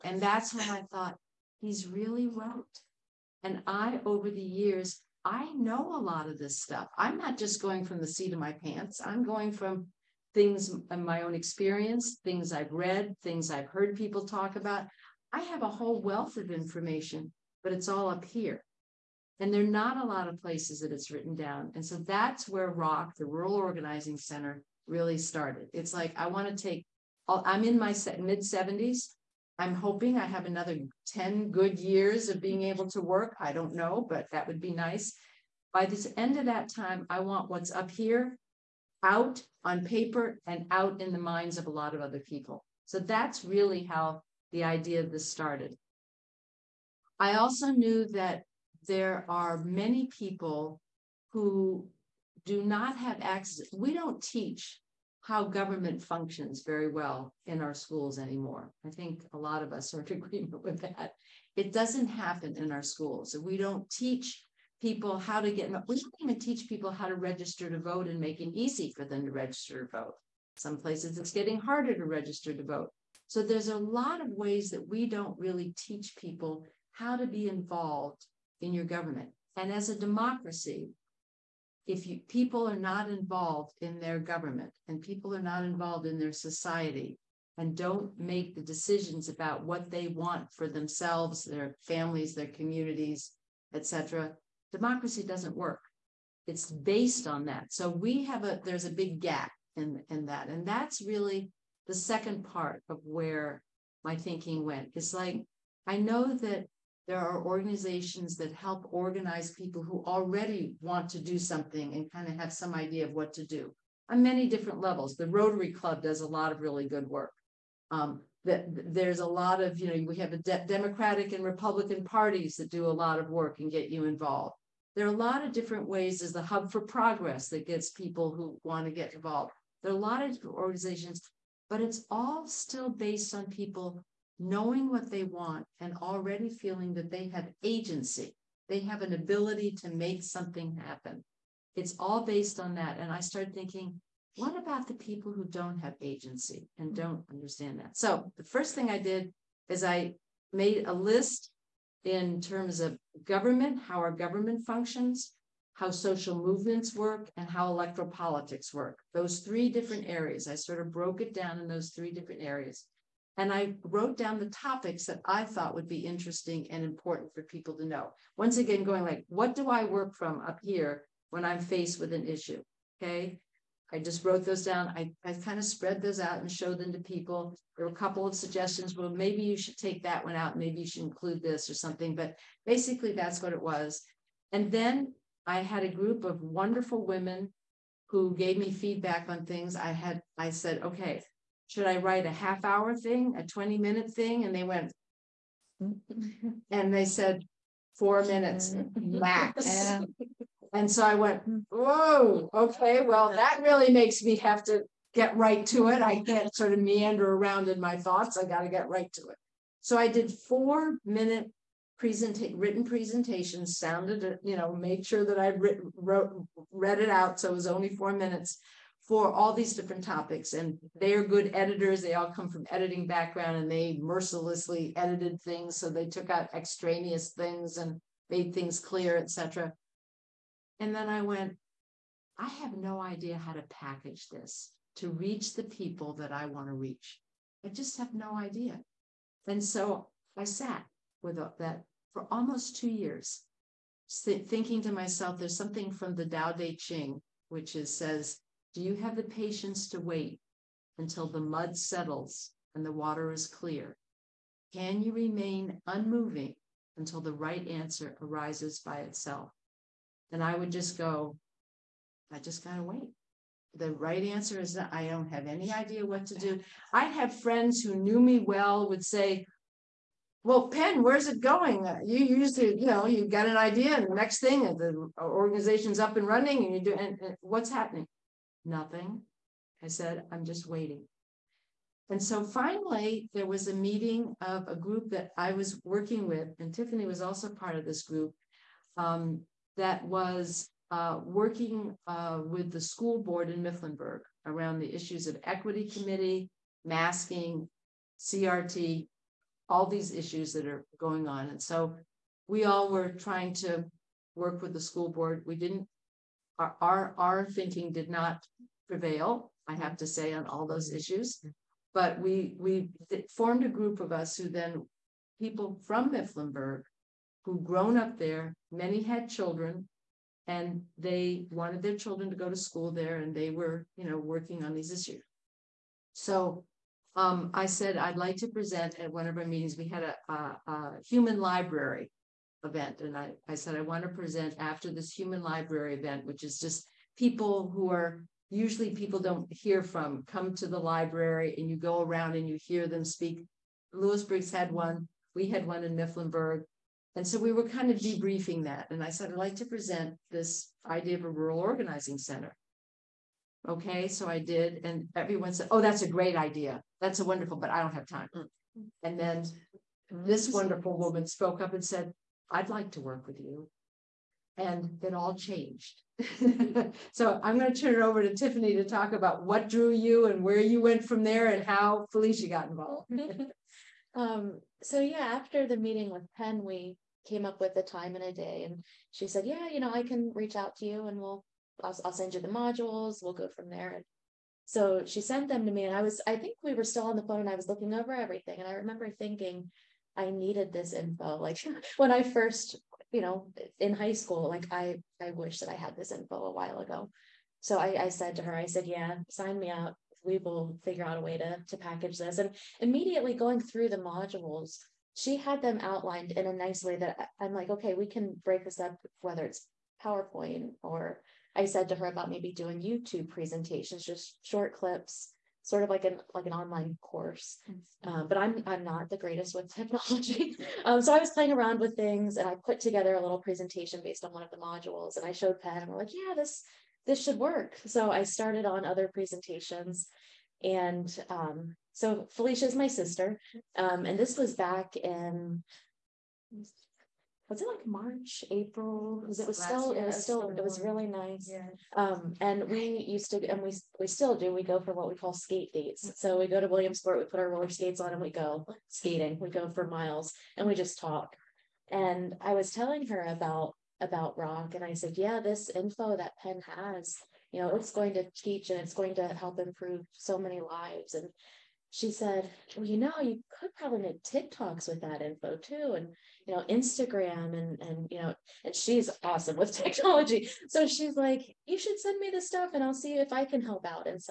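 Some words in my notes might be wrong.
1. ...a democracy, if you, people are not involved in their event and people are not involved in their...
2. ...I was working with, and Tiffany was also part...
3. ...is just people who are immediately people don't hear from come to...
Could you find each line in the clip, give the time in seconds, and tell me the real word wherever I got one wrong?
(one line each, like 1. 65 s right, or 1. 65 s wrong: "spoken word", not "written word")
1. 79 s wrong: "government", not "event"
2. 285 s right
3. 336 s wrong: "usually", not "immediately".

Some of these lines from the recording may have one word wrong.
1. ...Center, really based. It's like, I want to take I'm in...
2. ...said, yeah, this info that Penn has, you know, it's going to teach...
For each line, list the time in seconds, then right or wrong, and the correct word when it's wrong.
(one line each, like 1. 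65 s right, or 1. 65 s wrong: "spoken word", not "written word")
1. 24 s wrong: "started", not "based"
2. 454 s right.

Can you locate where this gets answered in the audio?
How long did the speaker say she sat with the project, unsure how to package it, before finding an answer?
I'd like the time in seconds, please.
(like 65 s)
242 s.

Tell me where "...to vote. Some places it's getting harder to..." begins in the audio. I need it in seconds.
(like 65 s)
69 s.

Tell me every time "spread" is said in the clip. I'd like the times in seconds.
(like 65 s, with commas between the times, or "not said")
175 s.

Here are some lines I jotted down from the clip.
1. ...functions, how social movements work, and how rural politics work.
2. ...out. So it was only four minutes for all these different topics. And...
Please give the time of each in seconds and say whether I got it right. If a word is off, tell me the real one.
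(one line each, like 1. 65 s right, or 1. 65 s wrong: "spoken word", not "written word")
1. 154 s wrong: "electoral", not "rural"
2. 217 s right.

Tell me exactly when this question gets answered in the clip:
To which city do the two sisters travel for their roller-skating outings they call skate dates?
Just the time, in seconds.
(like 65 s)
446 s.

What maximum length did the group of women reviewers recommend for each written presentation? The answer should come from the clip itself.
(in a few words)
4 minutes.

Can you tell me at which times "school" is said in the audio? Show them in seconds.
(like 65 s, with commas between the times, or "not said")
57 s, 62 s, 292 s, 304 s, 322 s, 394 s.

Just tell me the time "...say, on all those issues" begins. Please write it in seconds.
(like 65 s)
310 s.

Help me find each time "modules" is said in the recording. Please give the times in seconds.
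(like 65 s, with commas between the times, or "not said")
382 s, 403 s, 424 s.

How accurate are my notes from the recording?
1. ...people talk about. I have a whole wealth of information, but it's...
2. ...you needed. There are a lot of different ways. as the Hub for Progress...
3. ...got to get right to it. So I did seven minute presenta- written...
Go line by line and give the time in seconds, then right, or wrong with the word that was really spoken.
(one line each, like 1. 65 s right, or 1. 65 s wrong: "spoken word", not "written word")
1. 13 s right
2. 123 s wrong: "involved", not "needed"
3. 208 s wrong: "four", not "seven".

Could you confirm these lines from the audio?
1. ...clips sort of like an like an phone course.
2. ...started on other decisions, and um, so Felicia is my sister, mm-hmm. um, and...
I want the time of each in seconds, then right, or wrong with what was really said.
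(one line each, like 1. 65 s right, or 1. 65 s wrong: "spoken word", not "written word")
1. 414 s wrong: "online", not "phone"
2. 428 s wrong: "presentations", not "decisions".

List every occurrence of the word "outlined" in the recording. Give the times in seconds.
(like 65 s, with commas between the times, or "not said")
405 s.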